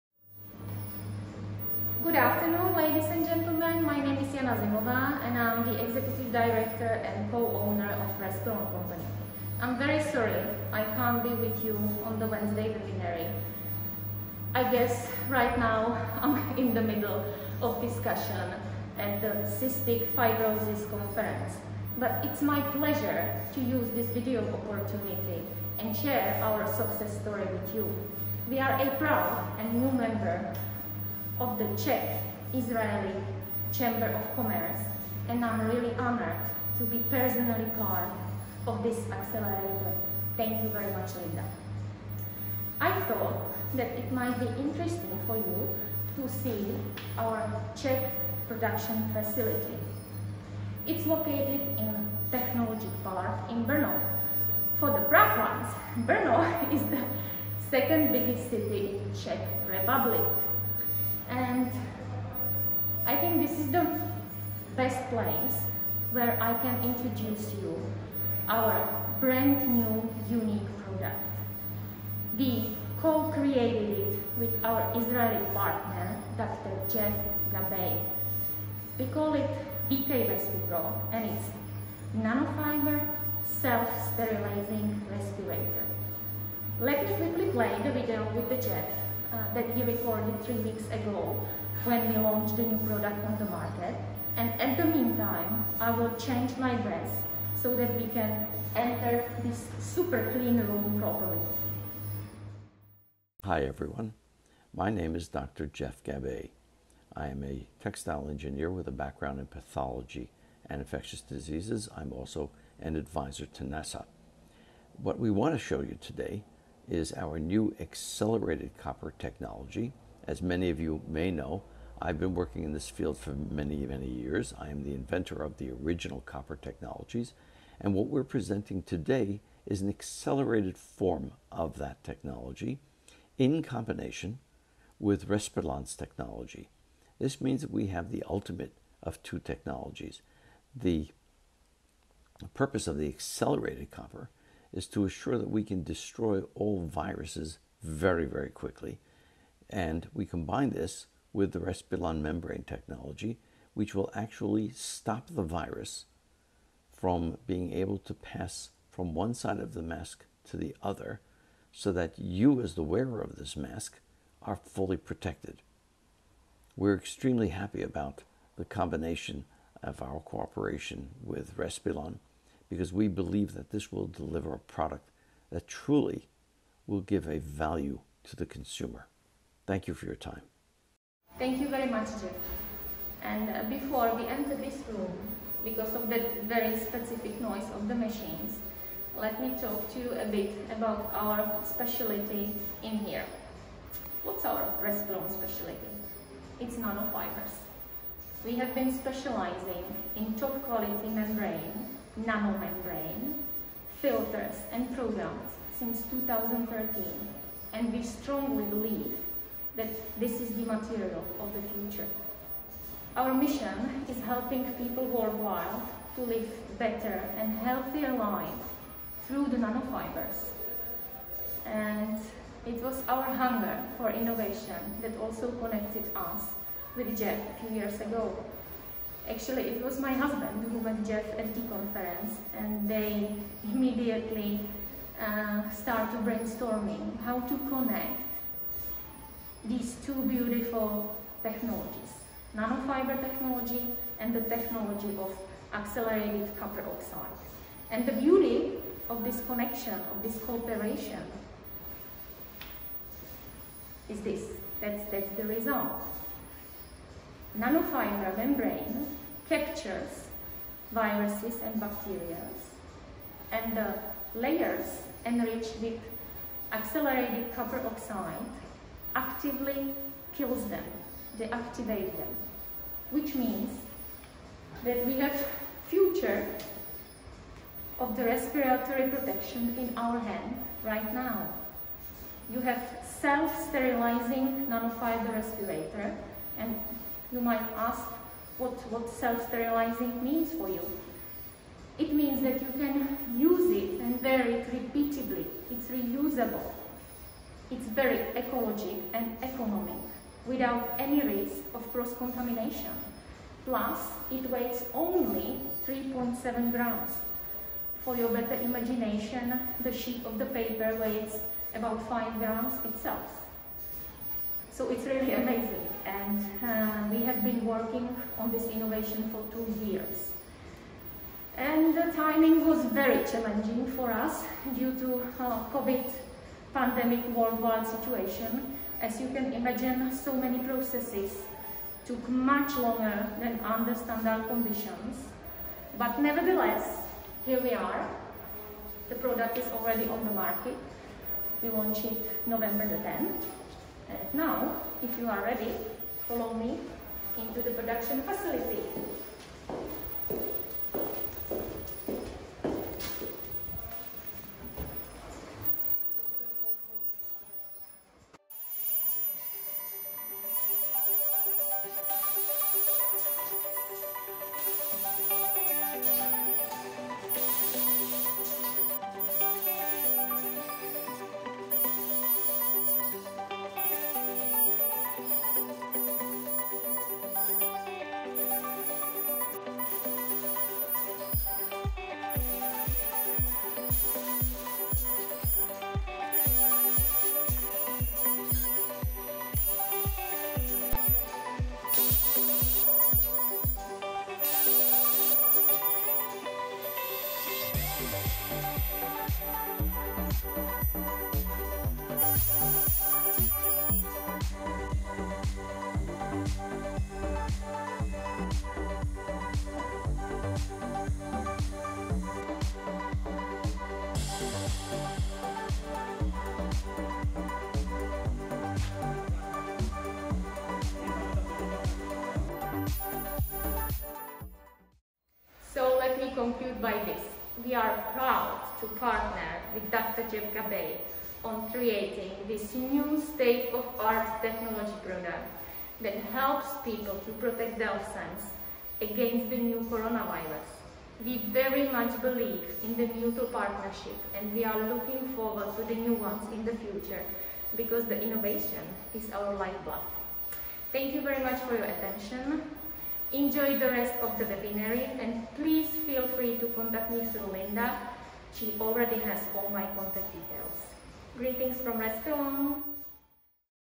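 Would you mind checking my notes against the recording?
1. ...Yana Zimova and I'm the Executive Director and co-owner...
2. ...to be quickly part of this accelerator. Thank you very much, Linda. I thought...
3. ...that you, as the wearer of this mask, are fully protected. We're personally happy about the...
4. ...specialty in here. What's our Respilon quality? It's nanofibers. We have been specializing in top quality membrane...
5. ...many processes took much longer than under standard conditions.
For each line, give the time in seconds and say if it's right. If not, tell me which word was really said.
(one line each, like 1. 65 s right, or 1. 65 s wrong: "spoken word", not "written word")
1. 4 s right
2. 36 s wrong: "personally", not "quickly"
3. 161 s wrong: "extremely", not "personally"
4. 191 s wrong: "specialty", not "quality"
5. 330 s right.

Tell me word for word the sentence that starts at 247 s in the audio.
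And the beauty of this connection, of this cooperation, is this.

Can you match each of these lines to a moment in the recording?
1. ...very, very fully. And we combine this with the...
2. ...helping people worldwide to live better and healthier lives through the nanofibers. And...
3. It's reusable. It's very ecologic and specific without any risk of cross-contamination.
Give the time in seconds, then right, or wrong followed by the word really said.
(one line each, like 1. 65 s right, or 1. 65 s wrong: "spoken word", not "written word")
1. 147 s wrong: "quickly", not "fully"
2. 214 s right
3. 295 s wrong: "economic", not "specific".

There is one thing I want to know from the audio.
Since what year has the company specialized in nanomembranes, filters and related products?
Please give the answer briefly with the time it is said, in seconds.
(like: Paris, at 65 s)
2013, at 206 s.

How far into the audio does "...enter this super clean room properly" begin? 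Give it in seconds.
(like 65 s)
98 s.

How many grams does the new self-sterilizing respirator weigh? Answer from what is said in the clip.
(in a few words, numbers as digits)
3.7 grams.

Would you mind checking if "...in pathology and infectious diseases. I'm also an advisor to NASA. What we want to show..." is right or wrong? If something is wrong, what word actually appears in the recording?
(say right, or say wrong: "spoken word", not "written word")
right.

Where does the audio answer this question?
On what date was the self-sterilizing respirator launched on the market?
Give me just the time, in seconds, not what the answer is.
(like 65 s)
342 s.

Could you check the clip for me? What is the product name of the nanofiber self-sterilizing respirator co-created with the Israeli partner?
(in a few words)
VK RespiPro.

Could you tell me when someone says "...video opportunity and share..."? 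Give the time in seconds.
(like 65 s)
24 s.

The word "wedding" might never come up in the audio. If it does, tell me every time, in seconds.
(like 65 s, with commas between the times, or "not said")
not said.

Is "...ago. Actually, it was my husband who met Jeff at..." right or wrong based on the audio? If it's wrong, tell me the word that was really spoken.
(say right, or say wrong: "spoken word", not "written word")
right.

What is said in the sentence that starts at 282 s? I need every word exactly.
You have self-sterilizing nanofiber respirator and you might ask what, what self-sterilizing means for you.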